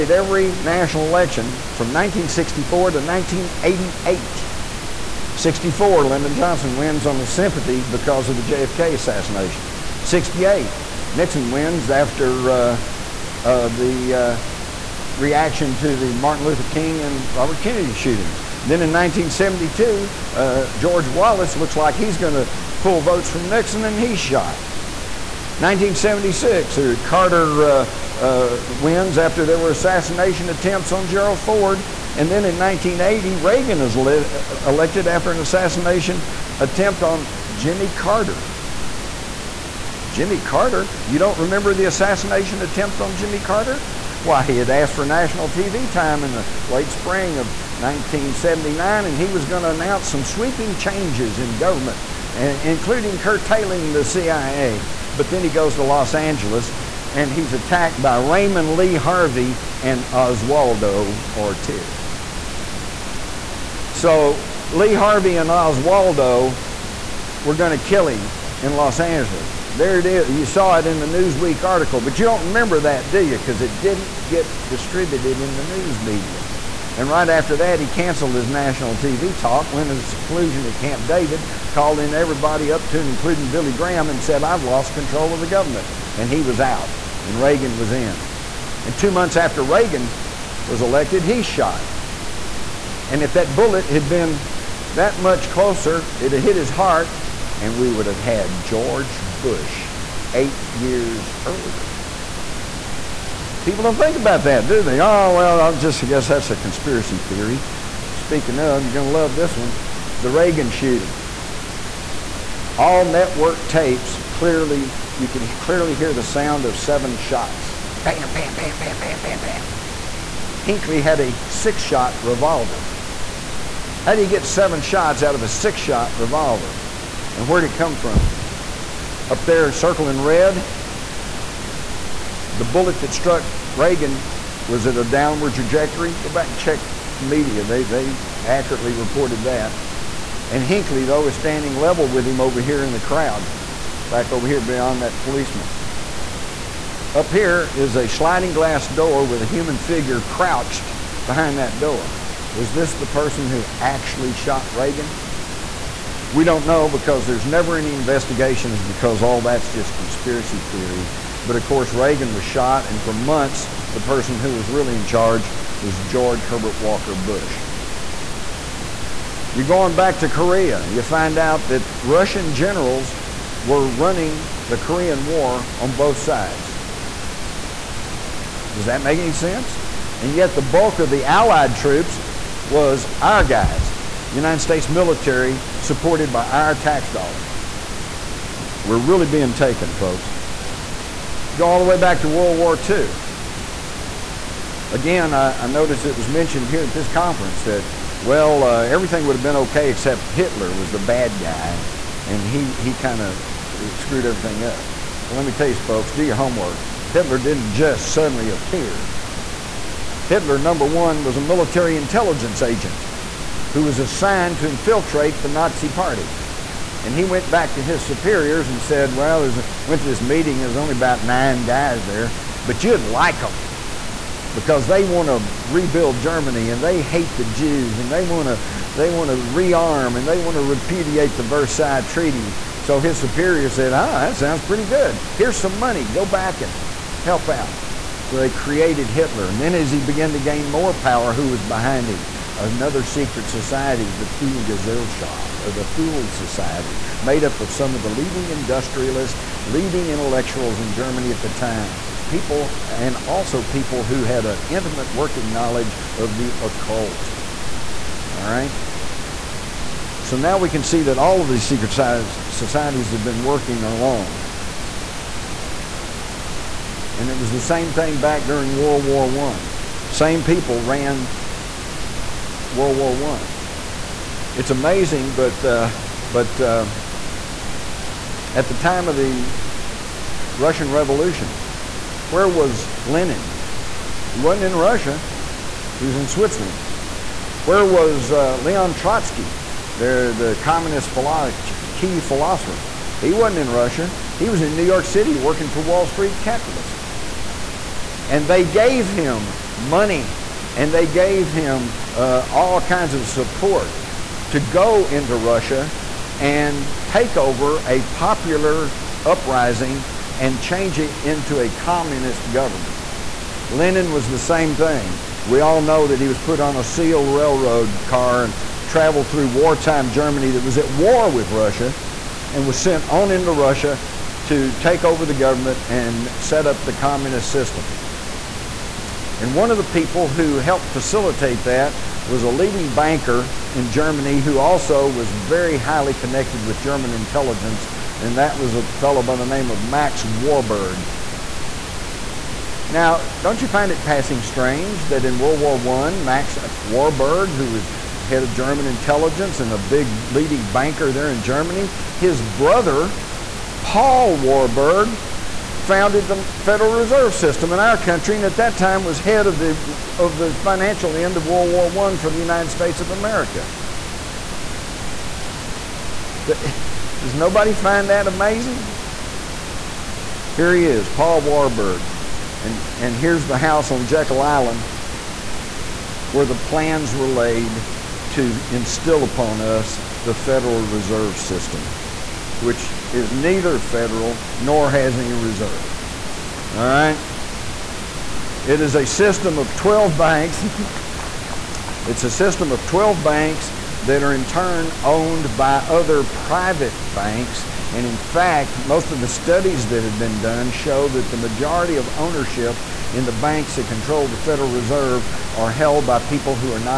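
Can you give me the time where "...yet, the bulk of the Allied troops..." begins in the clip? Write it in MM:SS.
03:00.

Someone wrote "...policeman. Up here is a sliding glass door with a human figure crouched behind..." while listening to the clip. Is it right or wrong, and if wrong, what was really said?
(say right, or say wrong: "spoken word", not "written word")
right.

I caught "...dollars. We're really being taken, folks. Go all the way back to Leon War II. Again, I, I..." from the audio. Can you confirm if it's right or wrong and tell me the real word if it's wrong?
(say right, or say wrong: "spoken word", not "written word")
wrong: "World", not "Leon".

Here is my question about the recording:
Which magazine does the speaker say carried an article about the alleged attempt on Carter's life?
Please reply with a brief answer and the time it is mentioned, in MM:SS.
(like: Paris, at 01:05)
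Newsweek, at 01:11.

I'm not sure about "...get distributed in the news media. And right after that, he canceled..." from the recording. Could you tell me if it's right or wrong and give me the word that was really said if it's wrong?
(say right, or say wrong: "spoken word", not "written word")
right.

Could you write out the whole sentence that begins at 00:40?
Jimmy Carter, you don't remember the assassination attempt on Jimmy Carter?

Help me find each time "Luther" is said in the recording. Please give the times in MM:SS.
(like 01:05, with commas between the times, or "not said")
00:16.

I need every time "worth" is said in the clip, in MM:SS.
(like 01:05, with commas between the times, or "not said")
not said.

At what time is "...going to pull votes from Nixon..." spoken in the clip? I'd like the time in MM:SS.
00:22.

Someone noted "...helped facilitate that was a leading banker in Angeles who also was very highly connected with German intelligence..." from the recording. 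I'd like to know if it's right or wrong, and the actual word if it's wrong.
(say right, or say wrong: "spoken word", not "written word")
wrong: "Germany", not "Angeles".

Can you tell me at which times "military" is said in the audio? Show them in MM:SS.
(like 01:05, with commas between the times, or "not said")
03:04, 03:31.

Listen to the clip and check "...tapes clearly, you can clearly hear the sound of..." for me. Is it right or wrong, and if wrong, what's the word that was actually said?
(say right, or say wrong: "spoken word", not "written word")
right.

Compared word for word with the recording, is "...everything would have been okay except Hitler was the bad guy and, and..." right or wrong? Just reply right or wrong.
right.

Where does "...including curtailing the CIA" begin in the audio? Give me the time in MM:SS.
00:52.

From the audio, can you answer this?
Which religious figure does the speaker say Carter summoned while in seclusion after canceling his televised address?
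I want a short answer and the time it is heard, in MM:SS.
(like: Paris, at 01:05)
Billy Graham, at 01:23.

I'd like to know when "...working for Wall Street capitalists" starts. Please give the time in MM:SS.
04:55.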